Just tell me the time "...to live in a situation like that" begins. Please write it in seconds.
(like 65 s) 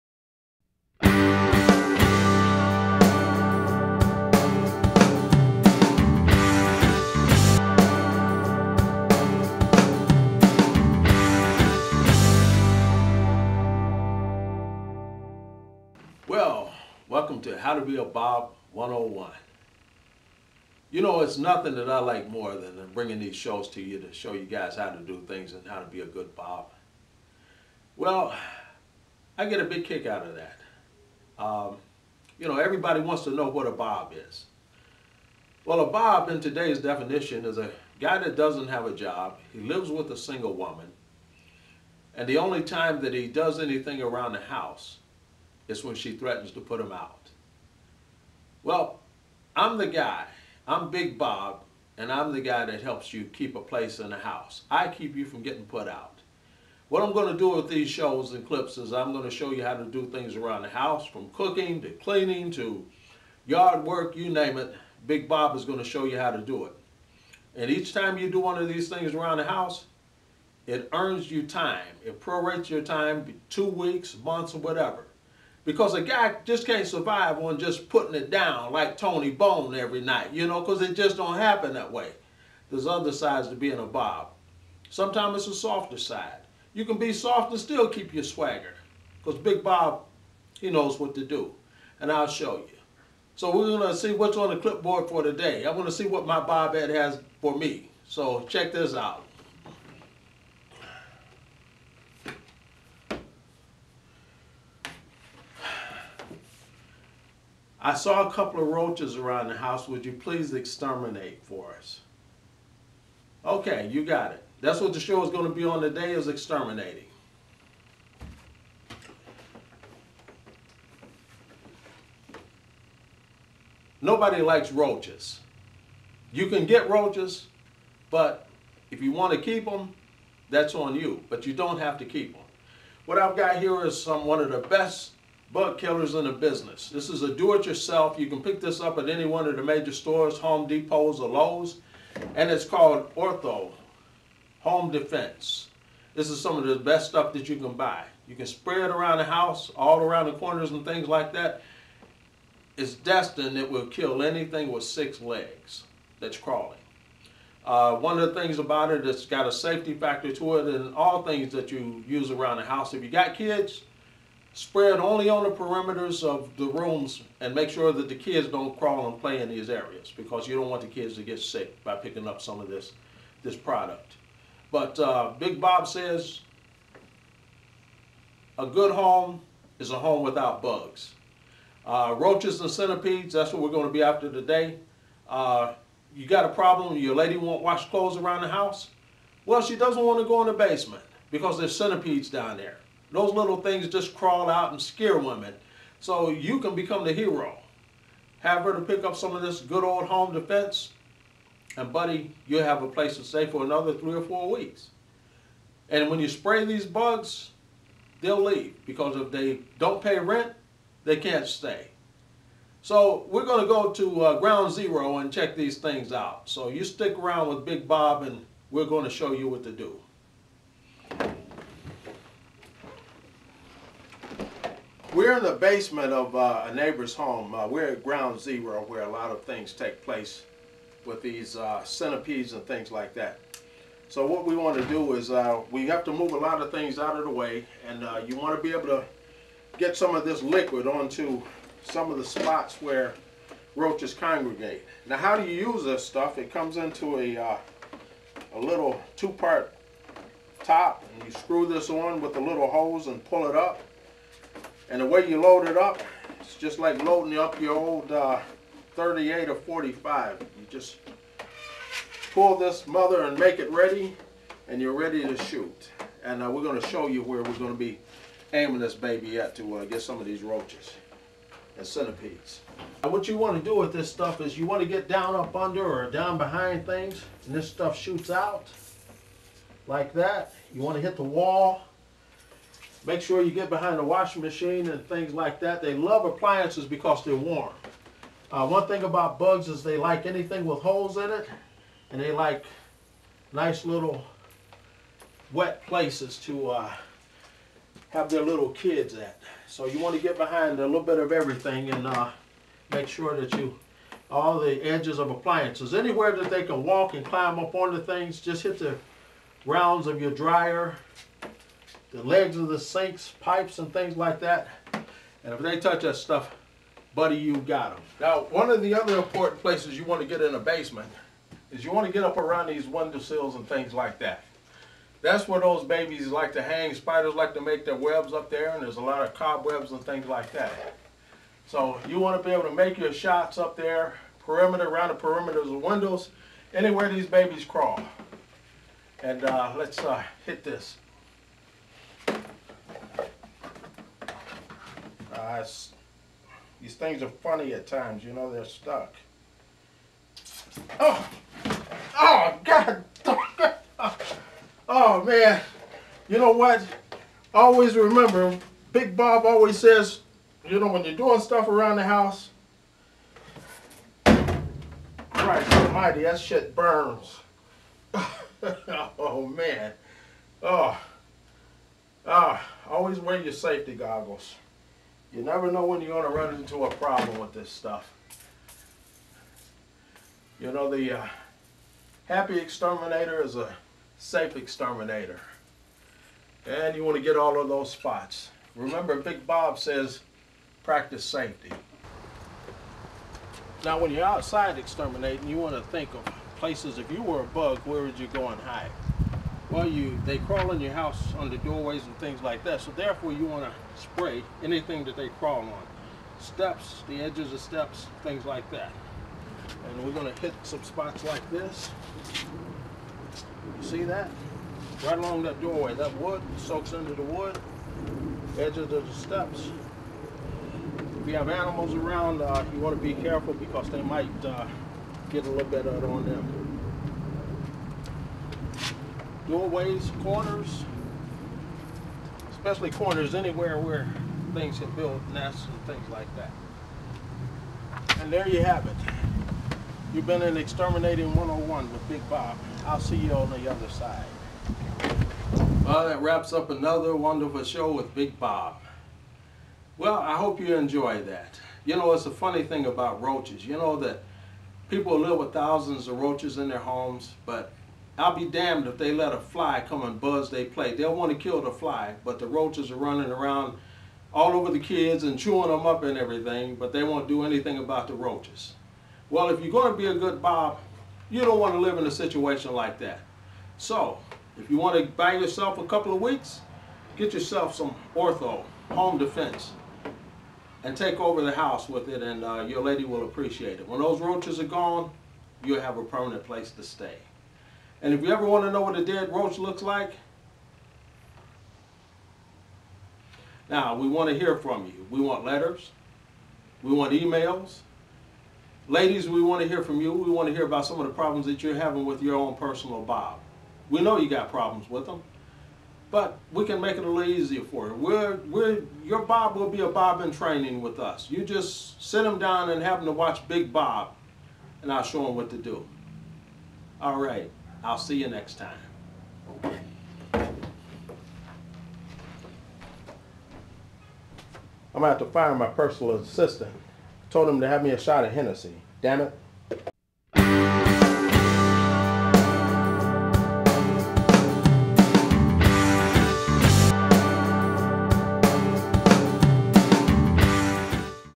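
471 s.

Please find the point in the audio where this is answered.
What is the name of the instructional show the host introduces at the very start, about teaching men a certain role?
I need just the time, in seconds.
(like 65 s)
17 s.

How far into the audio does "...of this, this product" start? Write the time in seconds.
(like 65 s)
172 s.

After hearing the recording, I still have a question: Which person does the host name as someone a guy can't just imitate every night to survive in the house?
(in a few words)
Tony Bone.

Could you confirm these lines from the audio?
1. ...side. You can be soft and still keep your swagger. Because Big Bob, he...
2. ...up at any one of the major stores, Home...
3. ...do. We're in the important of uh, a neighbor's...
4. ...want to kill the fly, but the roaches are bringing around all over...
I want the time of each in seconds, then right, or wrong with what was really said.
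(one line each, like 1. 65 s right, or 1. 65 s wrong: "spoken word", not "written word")
1. 85 s right
2. 138 s right
3. 219 s wrong: "basement", not "important"
4. 461 s wrong: "running", not "bringing".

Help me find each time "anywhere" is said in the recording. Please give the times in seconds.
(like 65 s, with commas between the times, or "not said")
305 s, 336 s, 433 s.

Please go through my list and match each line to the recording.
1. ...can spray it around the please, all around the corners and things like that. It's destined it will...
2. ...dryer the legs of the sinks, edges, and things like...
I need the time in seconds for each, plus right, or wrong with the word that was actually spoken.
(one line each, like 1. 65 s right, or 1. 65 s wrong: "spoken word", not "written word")
1. 148 s wrong: "house", not "please"
2. 310 s wrong: "pipes", not "edges".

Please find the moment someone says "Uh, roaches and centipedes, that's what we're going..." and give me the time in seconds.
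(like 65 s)
181 s.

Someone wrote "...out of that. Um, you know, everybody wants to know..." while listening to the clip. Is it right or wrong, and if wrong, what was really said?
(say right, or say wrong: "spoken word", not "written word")
right.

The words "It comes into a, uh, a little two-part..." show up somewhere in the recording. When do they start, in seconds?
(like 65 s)
246 s.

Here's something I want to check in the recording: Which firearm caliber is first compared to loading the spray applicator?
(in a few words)
38.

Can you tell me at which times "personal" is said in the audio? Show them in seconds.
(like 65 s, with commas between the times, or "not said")
502 s, 525 s.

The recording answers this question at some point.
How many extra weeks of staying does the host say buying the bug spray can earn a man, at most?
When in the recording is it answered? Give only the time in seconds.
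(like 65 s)
203 s.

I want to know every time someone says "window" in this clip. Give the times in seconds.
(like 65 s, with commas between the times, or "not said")
322 s, 335 s.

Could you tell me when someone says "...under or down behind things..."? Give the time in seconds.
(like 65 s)
275 s.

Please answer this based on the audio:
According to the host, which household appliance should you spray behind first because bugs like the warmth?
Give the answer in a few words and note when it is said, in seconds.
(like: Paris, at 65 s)
Washing machine, at 284 s.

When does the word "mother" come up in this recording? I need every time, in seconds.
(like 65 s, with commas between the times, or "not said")
262 s.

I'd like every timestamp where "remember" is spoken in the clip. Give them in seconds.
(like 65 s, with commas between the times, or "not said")
357 s, 388 s.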